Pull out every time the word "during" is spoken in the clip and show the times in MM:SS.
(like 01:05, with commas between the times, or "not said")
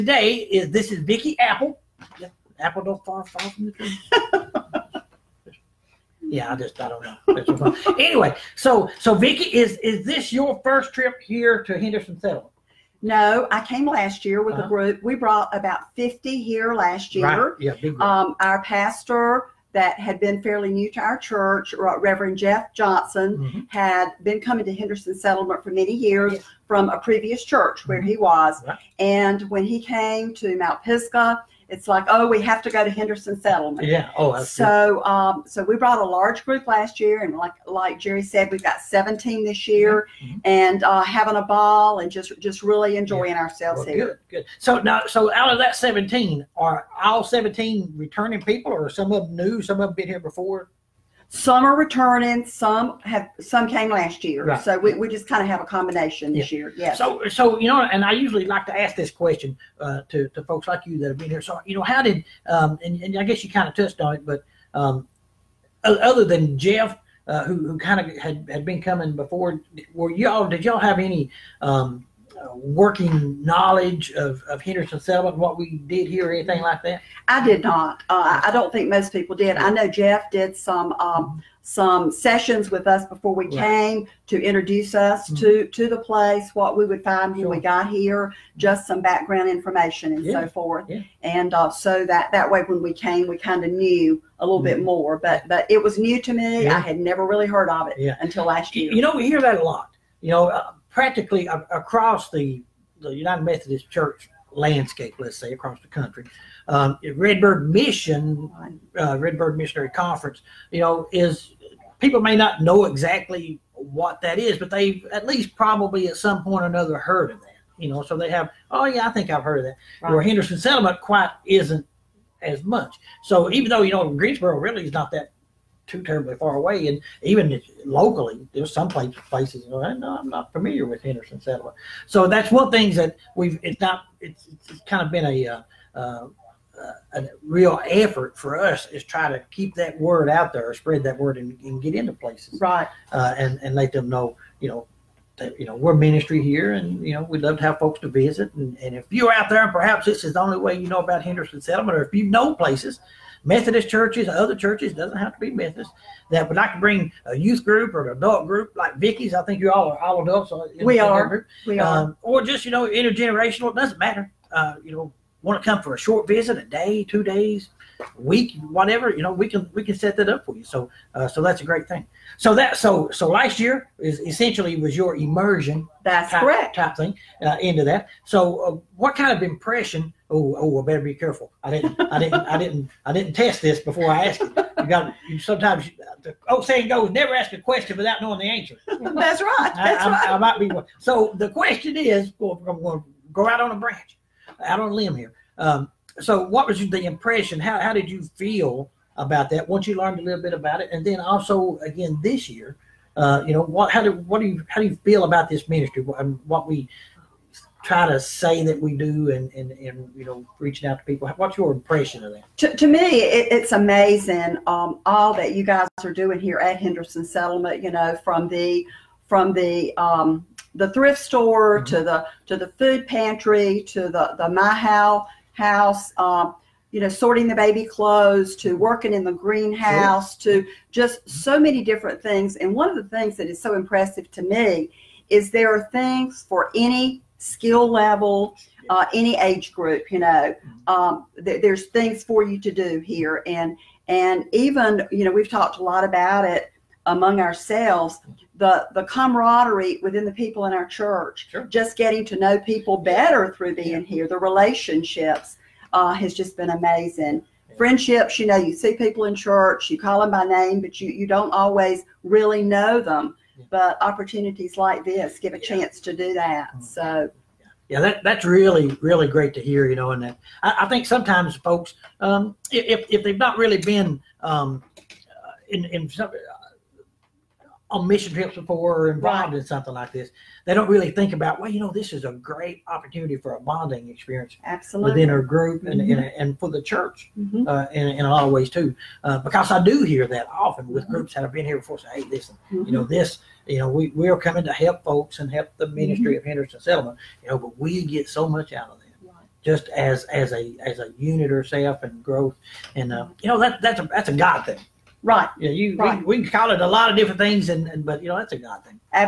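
not said.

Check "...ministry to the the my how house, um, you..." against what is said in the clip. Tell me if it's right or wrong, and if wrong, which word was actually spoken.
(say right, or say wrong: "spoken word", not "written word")
wrong: "pantry", not "ministry".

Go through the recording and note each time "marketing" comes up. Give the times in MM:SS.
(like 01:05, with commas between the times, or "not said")
not said.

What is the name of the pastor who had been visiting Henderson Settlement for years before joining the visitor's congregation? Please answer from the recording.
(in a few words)
Jeff Johnson.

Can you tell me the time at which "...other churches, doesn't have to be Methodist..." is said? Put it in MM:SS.
02:34.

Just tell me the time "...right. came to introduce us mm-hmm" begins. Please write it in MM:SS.
01:23.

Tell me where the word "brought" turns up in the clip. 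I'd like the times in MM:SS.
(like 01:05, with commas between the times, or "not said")
00:15, 00:35.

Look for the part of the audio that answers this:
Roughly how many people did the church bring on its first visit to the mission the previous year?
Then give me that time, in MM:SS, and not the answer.
00:15.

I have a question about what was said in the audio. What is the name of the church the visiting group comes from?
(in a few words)
Mount Pisgah.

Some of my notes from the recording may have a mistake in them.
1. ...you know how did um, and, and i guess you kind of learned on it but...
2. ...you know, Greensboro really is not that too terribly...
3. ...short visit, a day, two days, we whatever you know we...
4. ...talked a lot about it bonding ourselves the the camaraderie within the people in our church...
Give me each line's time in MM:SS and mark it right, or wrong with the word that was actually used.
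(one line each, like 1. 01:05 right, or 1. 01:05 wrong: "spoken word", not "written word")
1. 01:01 wrong: "touched", not "learned"
2. 02:03 right
3. 02:45 right
4. 04:05 wrong: "among", not "bonding".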